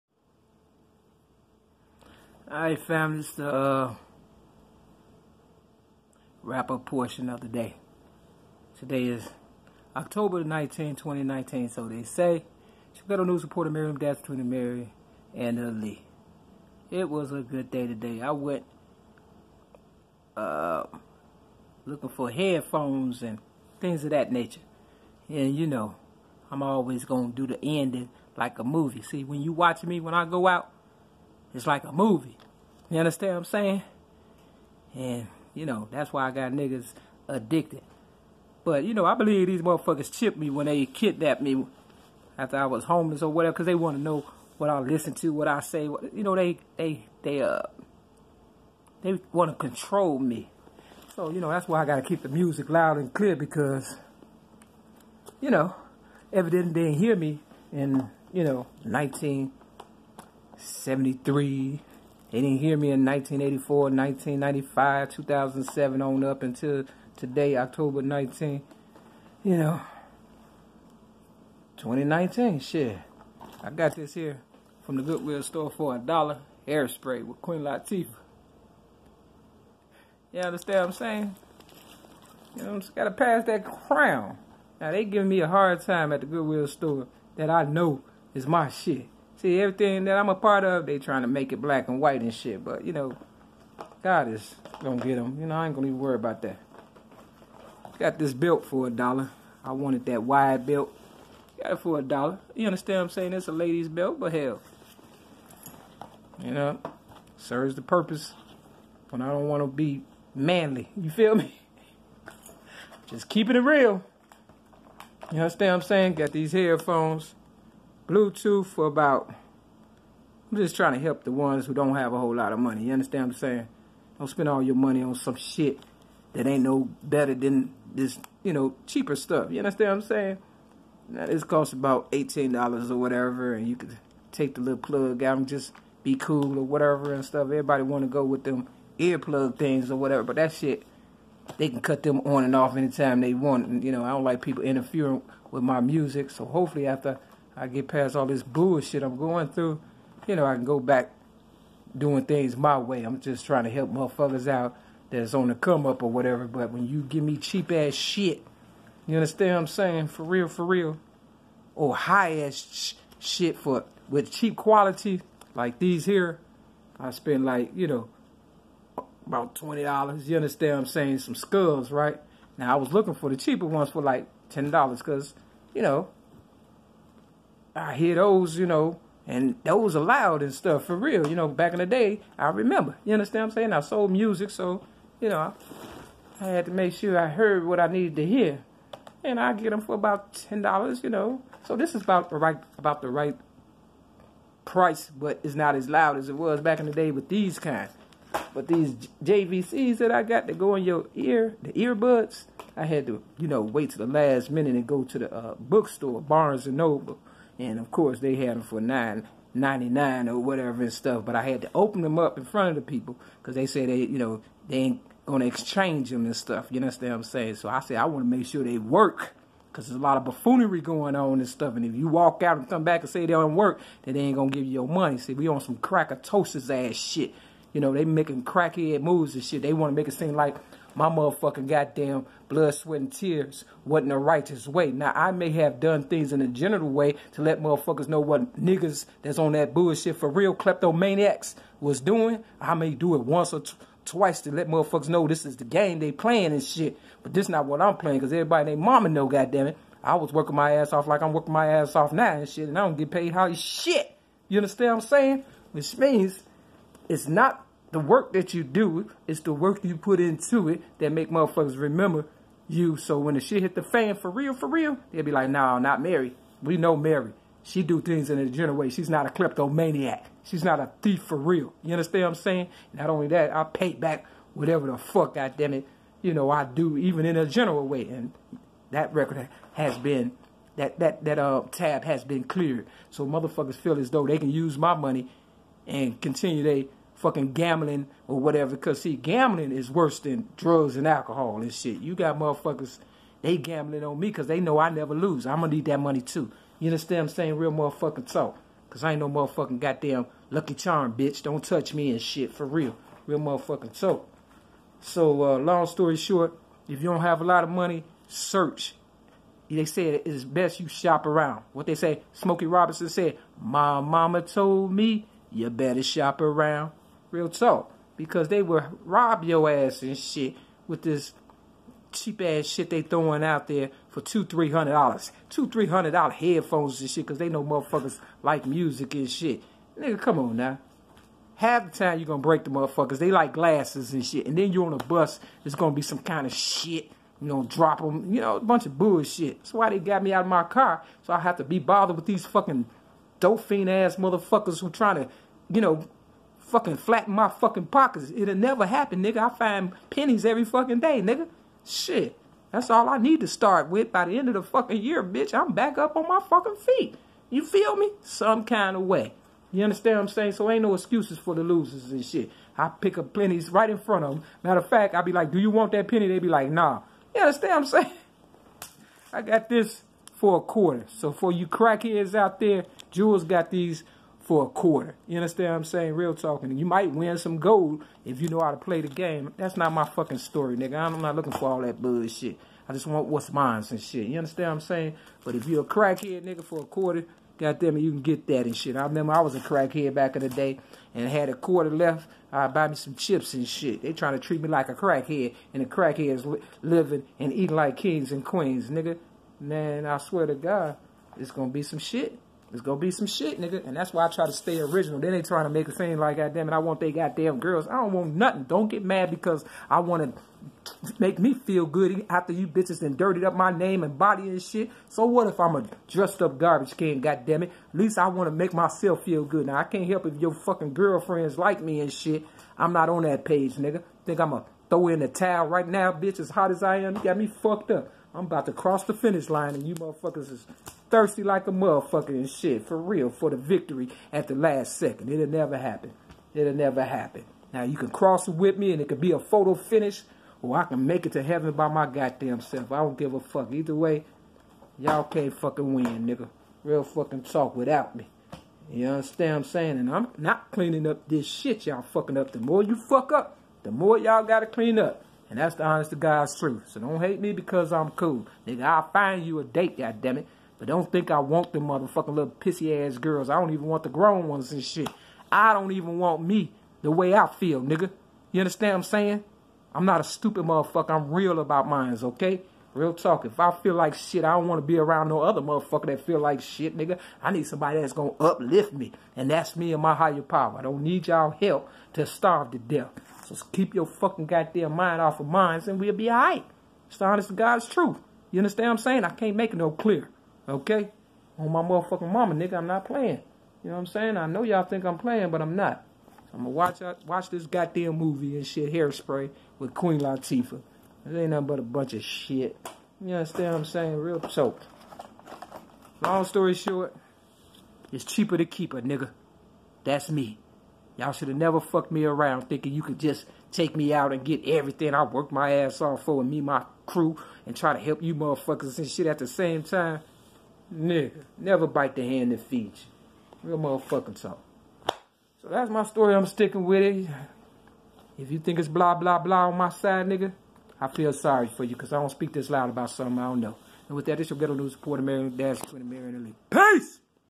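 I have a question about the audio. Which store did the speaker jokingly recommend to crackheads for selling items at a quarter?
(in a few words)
Jewel.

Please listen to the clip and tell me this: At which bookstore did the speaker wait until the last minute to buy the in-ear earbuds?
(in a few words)
Barnes and Noble.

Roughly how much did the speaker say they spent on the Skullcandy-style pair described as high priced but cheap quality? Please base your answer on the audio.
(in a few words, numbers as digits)
$20.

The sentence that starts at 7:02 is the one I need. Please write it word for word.
I'm not on that page, nigga.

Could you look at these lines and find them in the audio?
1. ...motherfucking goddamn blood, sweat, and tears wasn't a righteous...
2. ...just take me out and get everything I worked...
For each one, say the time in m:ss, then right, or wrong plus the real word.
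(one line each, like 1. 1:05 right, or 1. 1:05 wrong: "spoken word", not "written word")
1. 3:51 right
2. 8:33 right.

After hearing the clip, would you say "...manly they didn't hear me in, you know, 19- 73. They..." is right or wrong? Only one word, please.
wrong.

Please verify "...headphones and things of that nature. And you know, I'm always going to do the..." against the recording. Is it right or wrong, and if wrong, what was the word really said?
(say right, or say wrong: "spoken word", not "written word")
right.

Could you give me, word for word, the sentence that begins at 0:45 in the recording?
What, you know, they, they, they, uh, they want to control me.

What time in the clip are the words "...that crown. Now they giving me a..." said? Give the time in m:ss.
1:23.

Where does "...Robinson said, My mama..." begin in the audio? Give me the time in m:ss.
5:12.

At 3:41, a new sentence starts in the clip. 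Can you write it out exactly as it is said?
And if you walk out and come back and say they don't work, then they ain't gonna give you your money.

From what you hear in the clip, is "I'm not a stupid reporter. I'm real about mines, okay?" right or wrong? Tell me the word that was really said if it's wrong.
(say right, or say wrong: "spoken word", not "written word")
wrong: "motherfucker", not "reporter".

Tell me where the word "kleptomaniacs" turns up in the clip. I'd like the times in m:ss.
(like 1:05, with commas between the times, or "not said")
4:00, 4:29.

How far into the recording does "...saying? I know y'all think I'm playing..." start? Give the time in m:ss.
8:14.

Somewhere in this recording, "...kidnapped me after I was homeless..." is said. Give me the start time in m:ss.
0:40.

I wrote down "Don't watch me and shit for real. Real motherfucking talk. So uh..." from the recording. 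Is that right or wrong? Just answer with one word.
wrong.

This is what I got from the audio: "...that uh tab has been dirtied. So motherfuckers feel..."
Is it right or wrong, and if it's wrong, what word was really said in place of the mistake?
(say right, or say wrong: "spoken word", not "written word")
wrong: "cleared", not "dirtied".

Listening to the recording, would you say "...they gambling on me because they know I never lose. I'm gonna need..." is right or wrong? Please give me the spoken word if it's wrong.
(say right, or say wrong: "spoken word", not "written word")
right.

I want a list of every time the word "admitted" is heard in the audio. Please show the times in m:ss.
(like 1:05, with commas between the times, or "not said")
not said.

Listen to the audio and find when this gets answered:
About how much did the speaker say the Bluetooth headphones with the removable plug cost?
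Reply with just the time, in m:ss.
2:12.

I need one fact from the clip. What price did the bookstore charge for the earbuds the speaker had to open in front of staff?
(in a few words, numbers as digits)
$9.99.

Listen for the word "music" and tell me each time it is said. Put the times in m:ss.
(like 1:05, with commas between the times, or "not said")
0:52, 2:25, 3:04, 5:28.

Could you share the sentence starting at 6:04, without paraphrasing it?
Matter of fact, I'd be like, do you want that penny?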